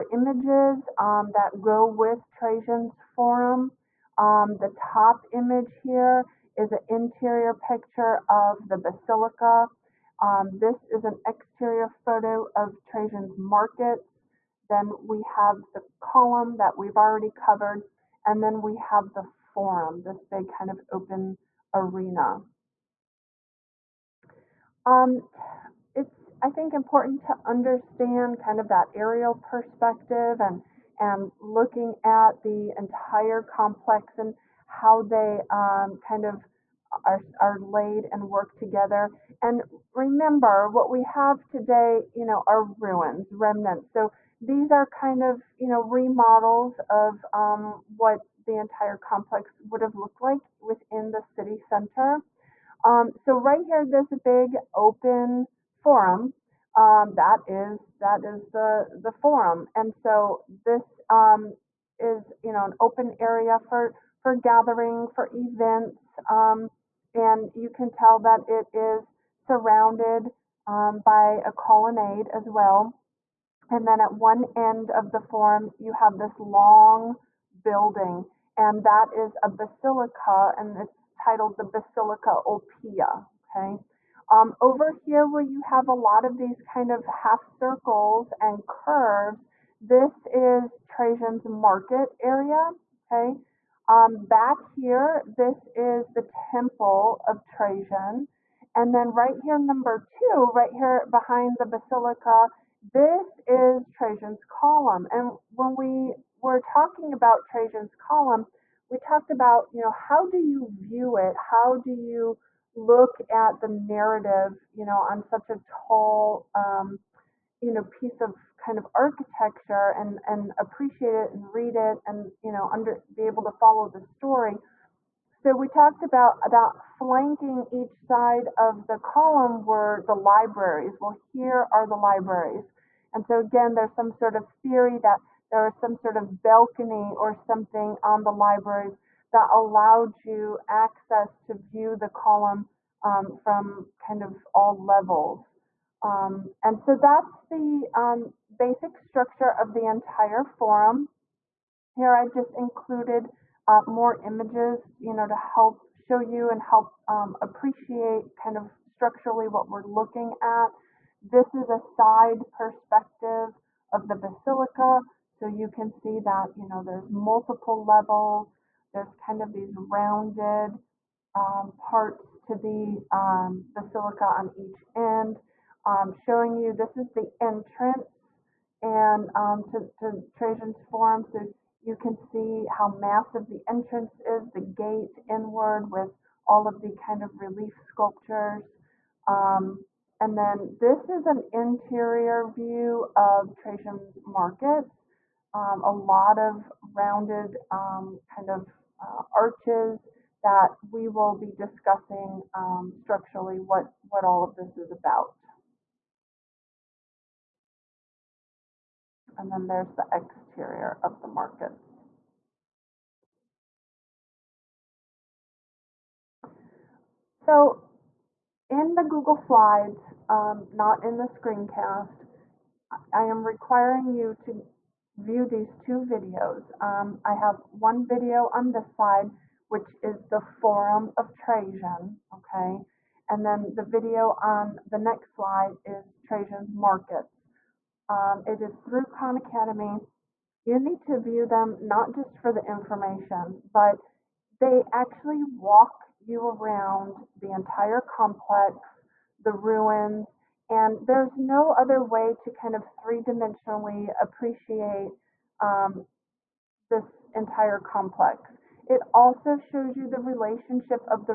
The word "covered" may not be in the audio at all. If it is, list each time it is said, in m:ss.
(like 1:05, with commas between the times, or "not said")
0:17.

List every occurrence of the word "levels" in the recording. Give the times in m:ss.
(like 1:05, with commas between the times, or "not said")
2:24, 2:47.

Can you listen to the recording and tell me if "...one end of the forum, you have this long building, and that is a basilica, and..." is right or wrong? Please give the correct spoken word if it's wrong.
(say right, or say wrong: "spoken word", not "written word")
right.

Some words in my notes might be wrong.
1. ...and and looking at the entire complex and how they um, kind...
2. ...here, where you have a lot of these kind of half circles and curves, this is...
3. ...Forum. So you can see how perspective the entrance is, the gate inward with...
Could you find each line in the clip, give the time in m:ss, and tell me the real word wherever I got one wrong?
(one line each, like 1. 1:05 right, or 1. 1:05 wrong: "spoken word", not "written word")
1. 0:30 right
2. 1:24 right
3. 3:00 wrong: "massive", not "perspective".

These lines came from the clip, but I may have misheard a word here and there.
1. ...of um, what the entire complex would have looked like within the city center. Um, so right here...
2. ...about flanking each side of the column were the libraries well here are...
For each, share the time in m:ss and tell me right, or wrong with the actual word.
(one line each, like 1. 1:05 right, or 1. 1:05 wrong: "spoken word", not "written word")
1. 0:46 right
2. 2:06 right.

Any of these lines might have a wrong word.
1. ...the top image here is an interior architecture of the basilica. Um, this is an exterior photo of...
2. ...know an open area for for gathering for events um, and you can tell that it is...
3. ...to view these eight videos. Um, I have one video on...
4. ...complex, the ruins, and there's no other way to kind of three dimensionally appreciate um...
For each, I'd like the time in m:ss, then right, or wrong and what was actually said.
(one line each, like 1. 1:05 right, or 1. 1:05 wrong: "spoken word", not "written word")
1. 0:04 wrong: "picture", not "architecture"
2. 1:02 right
3. 3:44 wrong: "two", not "eight"
4. 4:08 right.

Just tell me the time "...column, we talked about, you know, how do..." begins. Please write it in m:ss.
1:47.